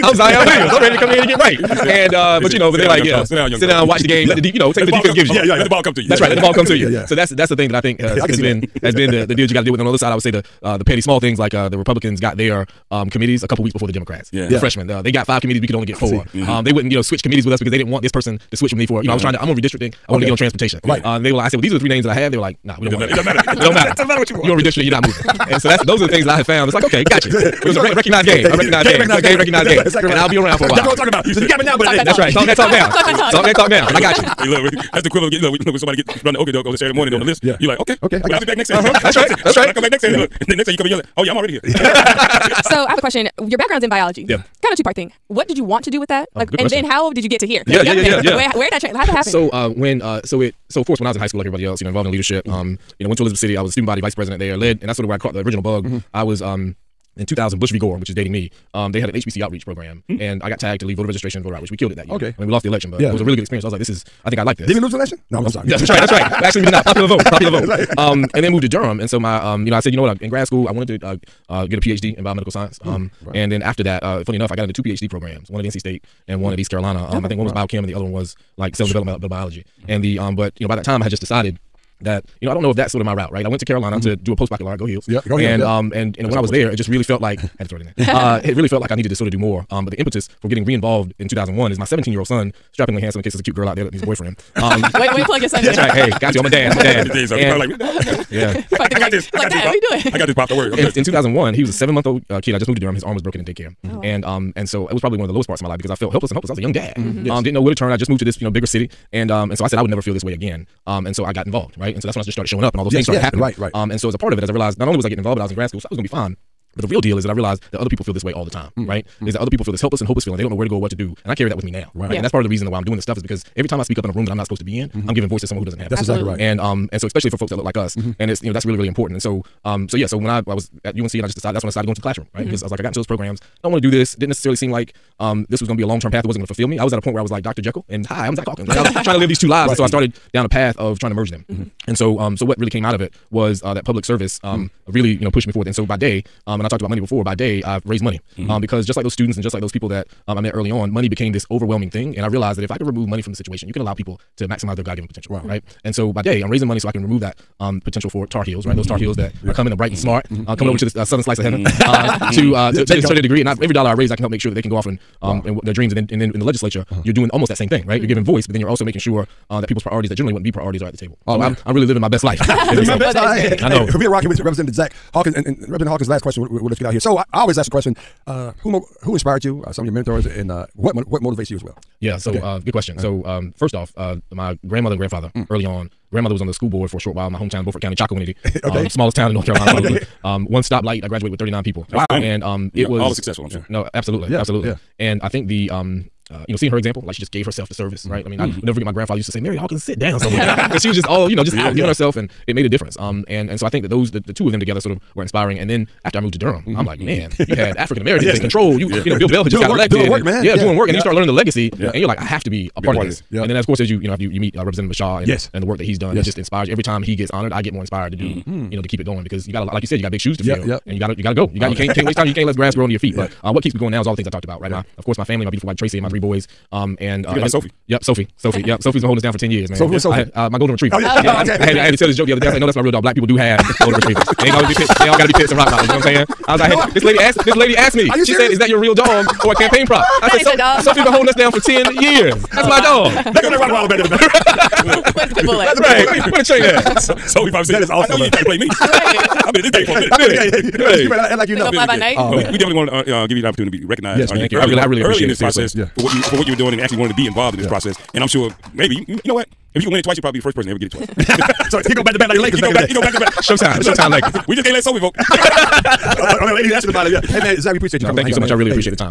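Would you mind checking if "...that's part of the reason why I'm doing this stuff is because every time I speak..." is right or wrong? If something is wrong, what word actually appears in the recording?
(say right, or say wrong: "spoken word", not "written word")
right.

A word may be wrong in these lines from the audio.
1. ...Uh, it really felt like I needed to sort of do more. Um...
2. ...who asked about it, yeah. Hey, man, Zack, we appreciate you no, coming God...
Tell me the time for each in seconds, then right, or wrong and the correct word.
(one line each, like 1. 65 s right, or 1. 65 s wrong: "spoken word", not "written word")
1. 87 s right
2. 266 s wrong: "Thank", not "God".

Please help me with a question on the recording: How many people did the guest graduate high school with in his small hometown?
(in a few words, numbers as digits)
39.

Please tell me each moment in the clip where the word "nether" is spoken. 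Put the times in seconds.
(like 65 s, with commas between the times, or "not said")
not said.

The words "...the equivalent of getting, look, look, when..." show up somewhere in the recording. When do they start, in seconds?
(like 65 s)
35 s.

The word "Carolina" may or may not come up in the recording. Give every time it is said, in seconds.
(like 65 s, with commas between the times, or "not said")
76 s, 83 s, 189 s.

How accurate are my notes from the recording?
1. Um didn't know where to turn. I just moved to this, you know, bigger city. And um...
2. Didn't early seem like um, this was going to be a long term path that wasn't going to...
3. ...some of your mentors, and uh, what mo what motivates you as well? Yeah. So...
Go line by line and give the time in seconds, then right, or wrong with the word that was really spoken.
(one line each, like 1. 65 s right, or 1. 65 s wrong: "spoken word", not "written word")
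1. 107 s right
2. 134 s wrong: "necessarily", not "early"
3. 179 s right.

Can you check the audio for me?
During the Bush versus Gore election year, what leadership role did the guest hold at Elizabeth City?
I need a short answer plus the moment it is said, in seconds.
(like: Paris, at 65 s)
Student body vice president, at 53 s.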